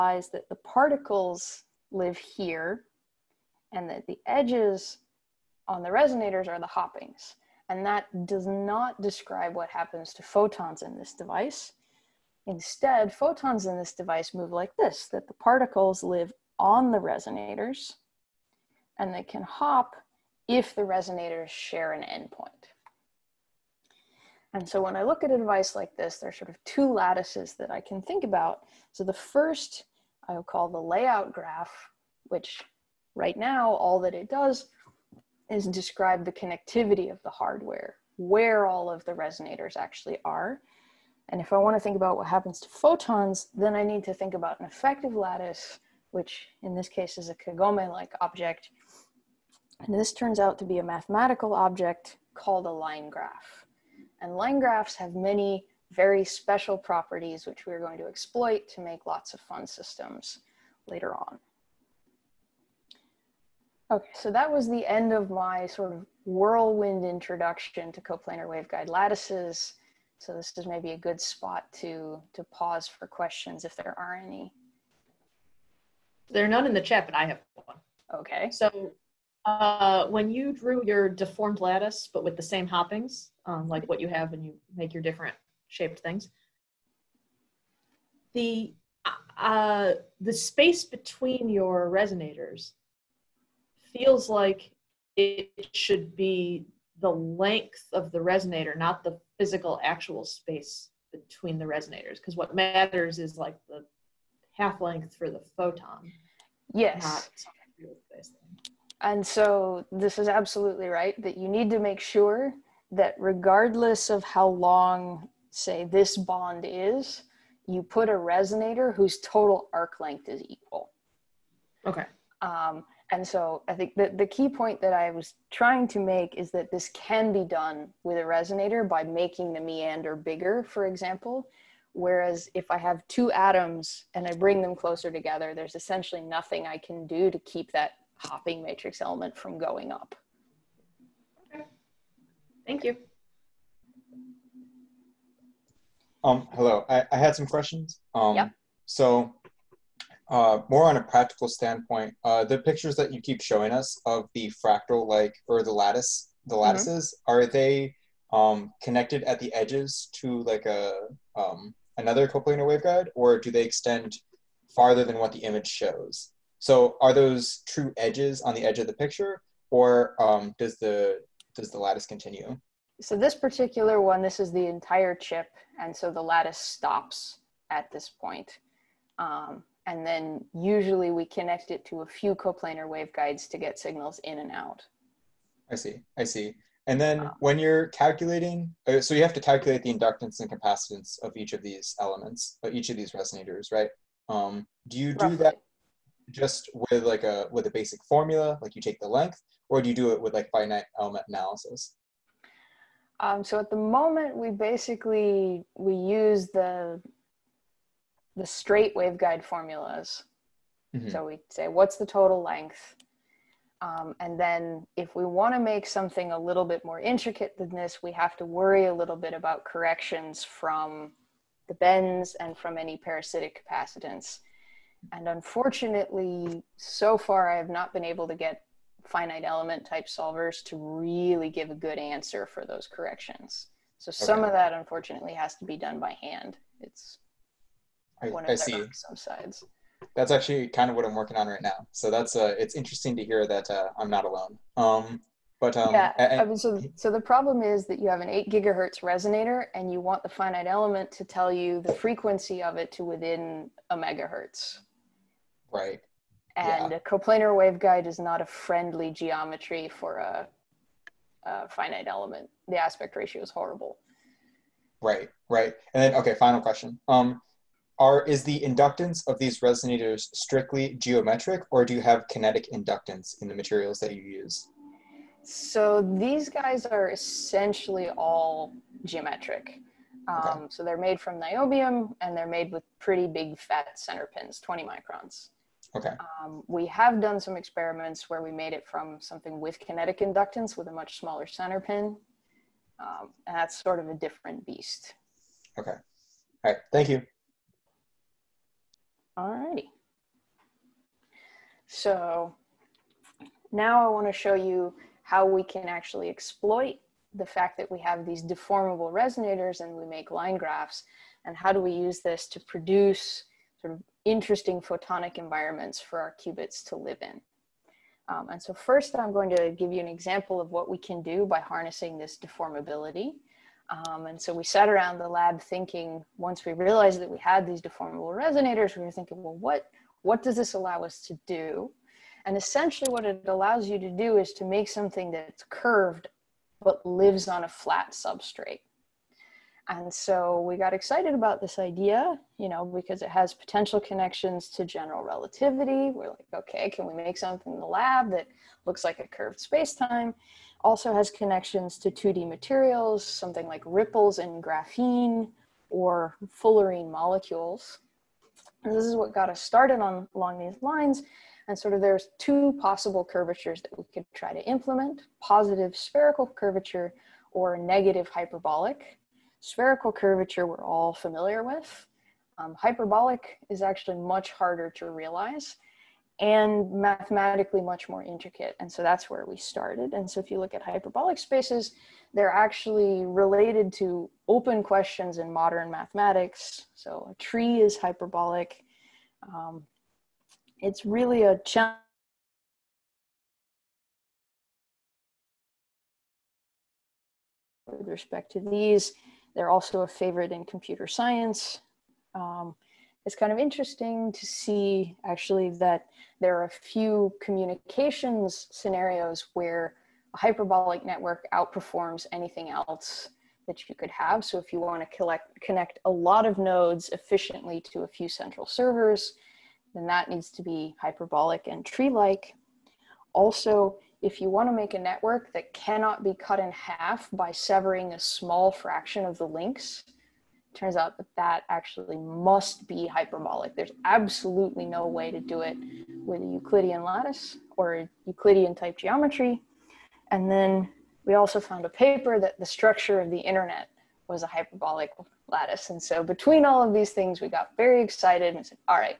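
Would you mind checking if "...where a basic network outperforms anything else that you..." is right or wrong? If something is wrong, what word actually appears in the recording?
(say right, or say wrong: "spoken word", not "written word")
wrong: "hyperbolic", not "basic".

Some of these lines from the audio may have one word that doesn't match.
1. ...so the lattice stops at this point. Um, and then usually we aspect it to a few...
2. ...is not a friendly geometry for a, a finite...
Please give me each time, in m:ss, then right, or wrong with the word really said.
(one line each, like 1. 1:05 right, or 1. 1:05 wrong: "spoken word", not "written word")
1. 2:55 wrong: "connect", not "aspect"
2. 4:18 right.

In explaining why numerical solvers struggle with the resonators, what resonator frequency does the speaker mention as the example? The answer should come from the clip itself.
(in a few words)
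8 gigahertz.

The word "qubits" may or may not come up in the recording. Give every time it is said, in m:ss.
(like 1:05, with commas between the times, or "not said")
5:16.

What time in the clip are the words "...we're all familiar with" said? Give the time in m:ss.
6:10.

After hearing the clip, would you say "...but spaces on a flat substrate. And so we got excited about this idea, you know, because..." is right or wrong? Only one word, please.
wrong.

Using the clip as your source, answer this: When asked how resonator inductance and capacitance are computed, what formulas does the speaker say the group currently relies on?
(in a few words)
straight waveguide formulas.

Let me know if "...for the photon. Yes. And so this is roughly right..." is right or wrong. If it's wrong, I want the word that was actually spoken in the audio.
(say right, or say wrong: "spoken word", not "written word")
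wrong: "absolutely", not "roughly".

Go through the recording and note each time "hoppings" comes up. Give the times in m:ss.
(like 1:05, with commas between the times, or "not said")
0:06, 1:22, 2:18.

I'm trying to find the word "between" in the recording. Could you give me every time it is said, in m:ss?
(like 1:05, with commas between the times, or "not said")
1:30, 1:41, 7:26.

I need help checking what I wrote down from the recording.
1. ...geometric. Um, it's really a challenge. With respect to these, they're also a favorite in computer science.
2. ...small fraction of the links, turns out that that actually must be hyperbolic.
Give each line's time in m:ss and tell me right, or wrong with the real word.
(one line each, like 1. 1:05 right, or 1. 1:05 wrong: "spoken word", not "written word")
1. 6:27 wrong: "hyperbolic", not "geometric"
2. 7:08 right.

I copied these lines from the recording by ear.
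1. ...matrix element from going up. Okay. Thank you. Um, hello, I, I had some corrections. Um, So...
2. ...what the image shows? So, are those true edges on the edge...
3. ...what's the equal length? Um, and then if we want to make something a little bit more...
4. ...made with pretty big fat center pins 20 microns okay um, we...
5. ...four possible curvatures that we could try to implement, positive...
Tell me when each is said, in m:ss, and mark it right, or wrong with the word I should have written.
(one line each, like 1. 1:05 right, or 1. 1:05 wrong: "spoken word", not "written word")
1. 2:18 wrong: "questions", not "corrections"
2. 2:45 right
3. 3:31 wrong: "total", not "equal"
4. 4:42 right
5. 6:02 wrong: "two", not "four".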